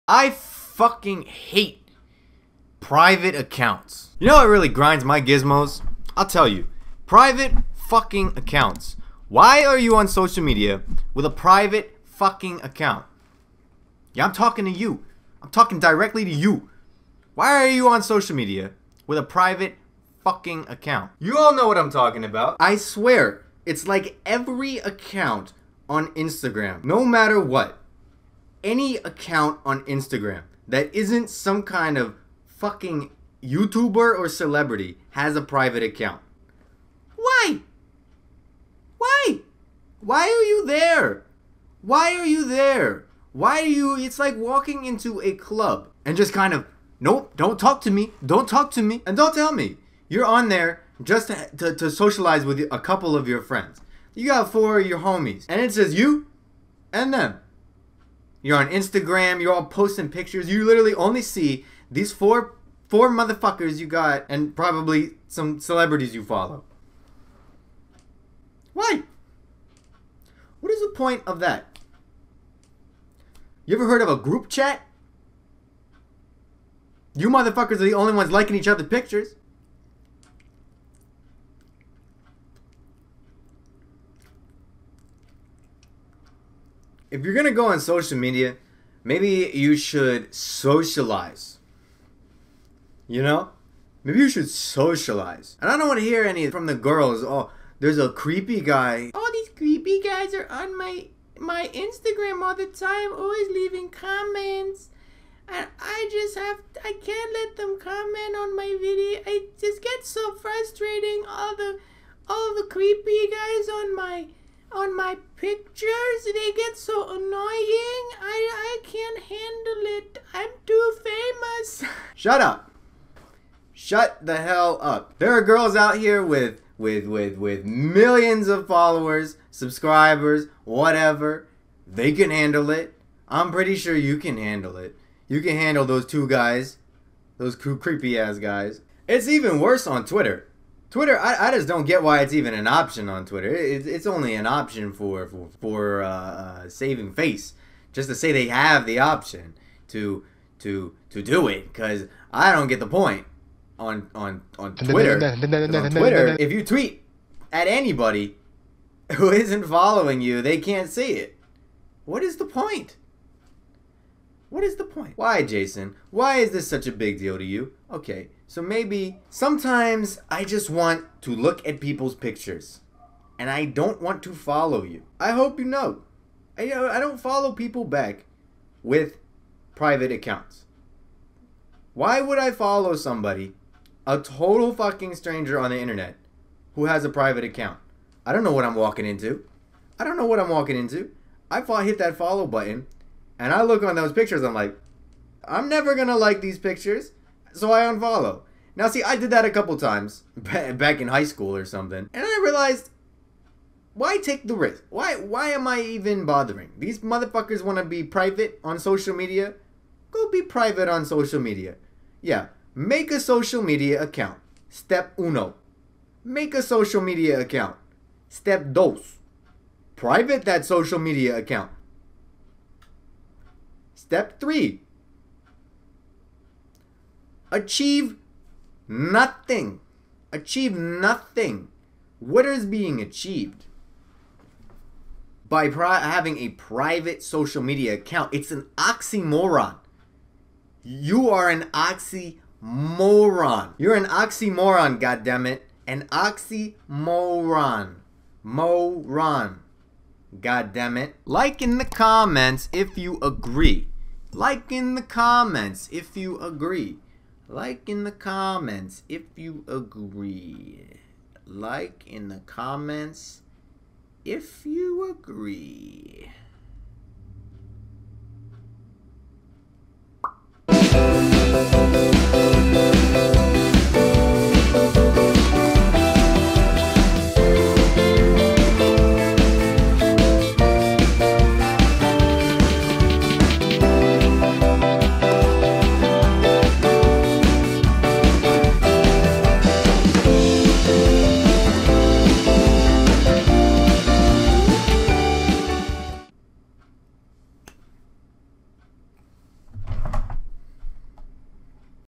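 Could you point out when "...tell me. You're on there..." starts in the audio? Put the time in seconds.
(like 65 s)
49 s.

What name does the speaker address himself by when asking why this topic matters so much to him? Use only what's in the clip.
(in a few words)
Jason.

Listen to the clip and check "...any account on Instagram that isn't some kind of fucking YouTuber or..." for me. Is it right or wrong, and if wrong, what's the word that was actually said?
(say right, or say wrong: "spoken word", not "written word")
right.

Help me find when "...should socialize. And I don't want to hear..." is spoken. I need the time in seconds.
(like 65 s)
94 s.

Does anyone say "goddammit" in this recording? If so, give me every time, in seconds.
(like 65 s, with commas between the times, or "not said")
245 s, 250 s.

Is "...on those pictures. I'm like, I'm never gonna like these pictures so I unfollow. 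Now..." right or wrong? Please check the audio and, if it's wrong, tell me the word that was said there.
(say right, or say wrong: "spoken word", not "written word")
right.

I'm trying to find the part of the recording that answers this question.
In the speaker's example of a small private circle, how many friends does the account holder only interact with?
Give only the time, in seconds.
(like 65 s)
54 s.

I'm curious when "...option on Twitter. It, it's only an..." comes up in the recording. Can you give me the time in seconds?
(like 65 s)
142 s.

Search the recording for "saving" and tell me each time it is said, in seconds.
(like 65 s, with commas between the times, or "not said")
146 s.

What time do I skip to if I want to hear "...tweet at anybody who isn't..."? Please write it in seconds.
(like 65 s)
156 s.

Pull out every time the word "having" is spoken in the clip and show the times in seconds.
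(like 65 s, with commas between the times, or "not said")
235 s.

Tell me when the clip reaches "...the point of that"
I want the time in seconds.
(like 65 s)
70 s.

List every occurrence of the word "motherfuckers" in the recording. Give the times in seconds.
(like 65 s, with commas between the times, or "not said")
63 s, 77 s, 206 s.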